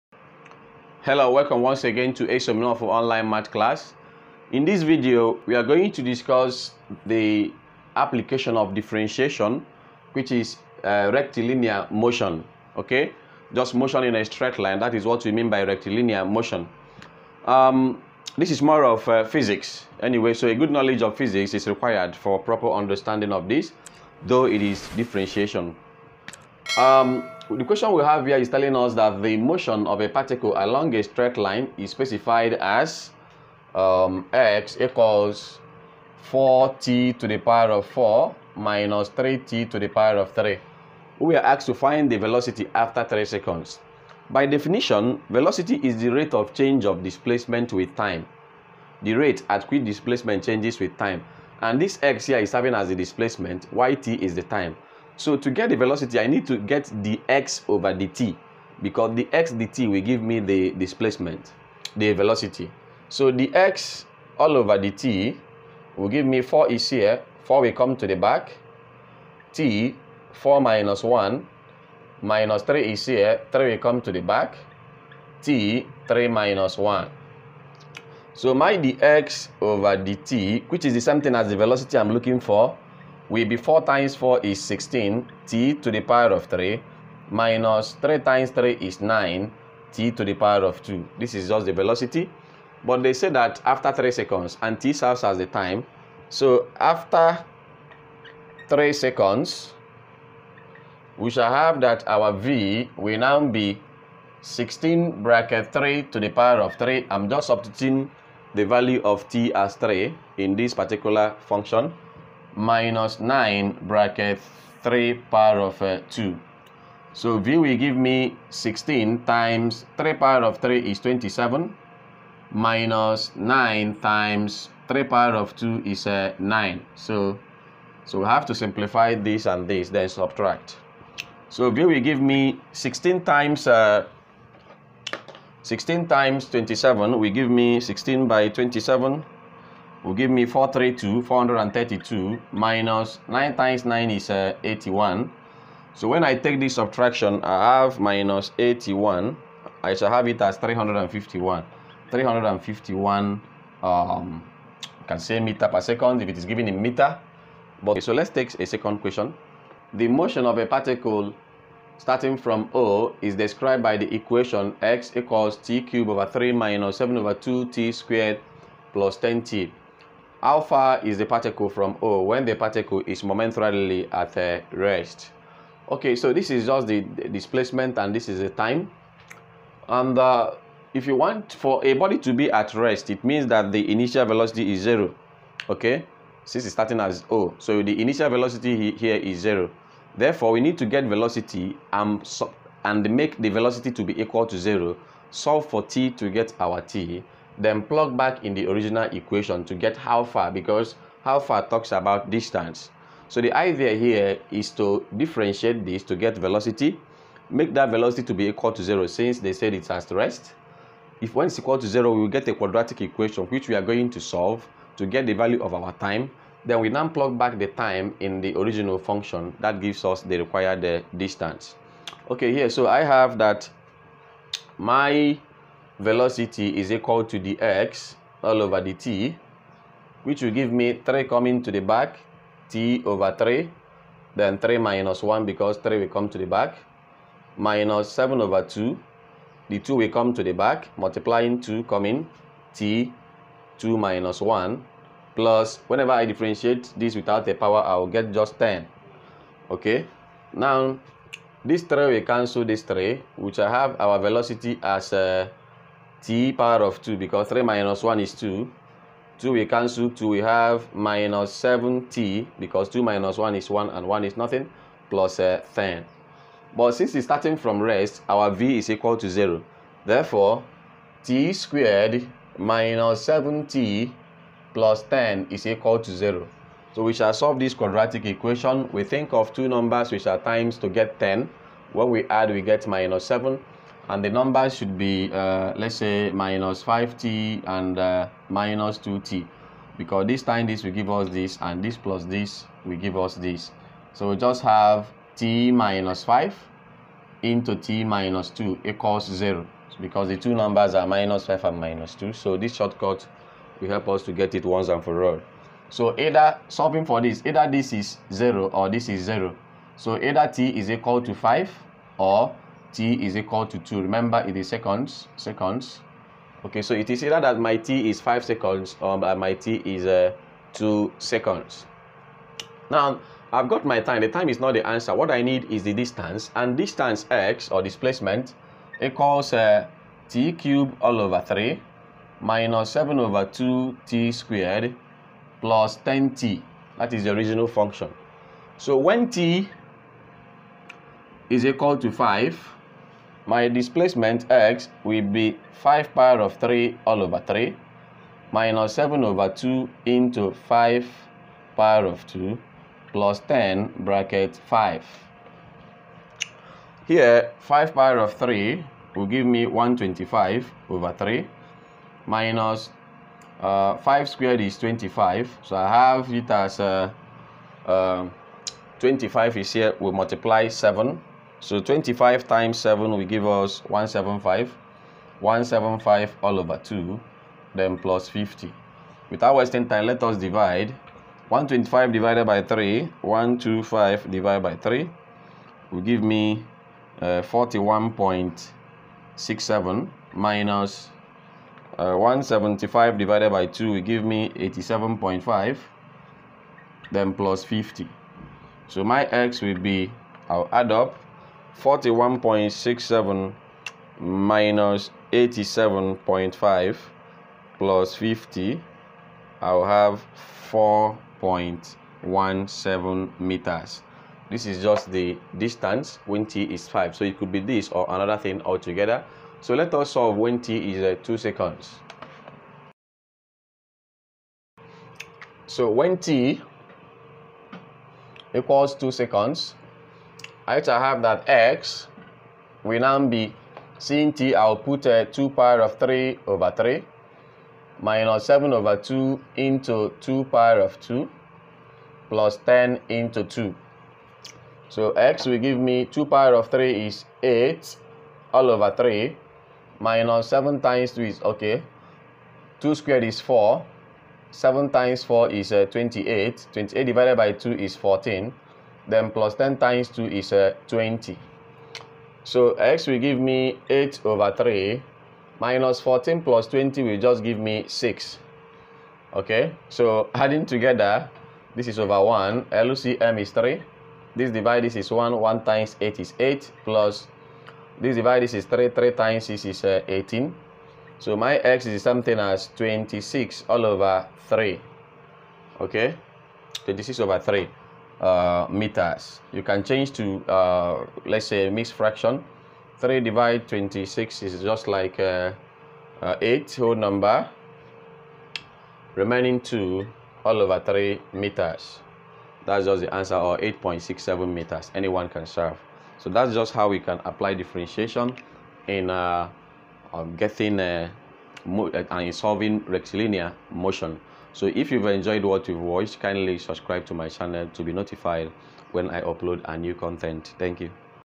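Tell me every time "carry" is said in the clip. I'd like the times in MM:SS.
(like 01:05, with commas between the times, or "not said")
not said.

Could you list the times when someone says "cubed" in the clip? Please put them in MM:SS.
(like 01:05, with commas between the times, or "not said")
02:45, 05:30.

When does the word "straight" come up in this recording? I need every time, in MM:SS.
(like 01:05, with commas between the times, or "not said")
00:14, 00:31.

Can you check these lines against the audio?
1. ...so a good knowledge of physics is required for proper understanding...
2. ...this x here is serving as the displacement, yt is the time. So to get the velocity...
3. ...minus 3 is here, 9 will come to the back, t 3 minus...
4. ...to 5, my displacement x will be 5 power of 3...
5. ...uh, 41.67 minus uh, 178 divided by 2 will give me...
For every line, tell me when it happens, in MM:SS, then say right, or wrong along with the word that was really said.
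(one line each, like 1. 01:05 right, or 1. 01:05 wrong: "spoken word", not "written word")
1. 00:20 right
2. 00:51 right
3. 01:12 wrong: "3", not "9"
4. 05:41 right
5. 06:27 wrong: "175", not "178".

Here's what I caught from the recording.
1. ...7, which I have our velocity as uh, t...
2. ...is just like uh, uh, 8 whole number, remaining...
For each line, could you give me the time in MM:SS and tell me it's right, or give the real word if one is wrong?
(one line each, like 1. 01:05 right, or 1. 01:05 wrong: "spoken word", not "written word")
1. 04:12 wrong: "3", not "7"
2. 08:14 right.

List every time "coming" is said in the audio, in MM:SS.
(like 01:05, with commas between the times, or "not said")
03:51, 04:01.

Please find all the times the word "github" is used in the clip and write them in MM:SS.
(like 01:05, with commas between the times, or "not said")
not said.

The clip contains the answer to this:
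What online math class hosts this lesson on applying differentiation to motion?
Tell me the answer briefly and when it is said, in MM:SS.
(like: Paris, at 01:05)
Esomnofu Online Math class, at 00:02.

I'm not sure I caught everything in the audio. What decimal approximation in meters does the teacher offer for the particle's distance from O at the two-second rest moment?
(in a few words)
8.67 meters.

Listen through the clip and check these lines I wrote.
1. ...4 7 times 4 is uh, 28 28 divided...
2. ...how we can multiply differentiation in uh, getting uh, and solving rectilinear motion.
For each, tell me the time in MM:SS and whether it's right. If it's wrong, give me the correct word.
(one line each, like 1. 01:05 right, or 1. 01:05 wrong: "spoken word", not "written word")
1. 07:33 right
2. 08:26 wrong: "apply", not "multiply".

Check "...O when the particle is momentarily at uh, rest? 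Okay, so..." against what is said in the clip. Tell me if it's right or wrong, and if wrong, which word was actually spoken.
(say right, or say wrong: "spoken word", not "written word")
right.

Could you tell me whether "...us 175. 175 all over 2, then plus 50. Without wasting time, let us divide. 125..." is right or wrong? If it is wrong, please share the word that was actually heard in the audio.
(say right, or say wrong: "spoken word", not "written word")
right.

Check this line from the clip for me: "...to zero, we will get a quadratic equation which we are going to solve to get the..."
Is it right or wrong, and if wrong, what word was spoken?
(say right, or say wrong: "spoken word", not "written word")
right.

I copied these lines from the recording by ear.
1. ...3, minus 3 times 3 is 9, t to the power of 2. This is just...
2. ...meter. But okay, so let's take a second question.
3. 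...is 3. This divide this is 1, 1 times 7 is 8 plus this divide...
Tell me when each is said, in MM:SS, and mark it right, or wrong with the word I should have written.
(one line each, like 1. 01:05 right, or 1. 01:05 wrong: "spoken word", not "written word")
1. 01:26 right
2. 02:36 right
3. 07:53 wrong: "8", not "7".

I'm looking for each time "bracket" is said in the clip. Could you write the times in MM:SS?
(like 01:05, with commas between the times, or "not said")
01:45, 01:53, 05:53.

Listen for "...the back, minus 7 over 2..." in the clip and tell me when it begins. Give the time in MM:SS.
03:56.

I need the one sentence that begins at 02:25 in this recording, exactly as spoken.
So when I take this subtraction, I have minus 81.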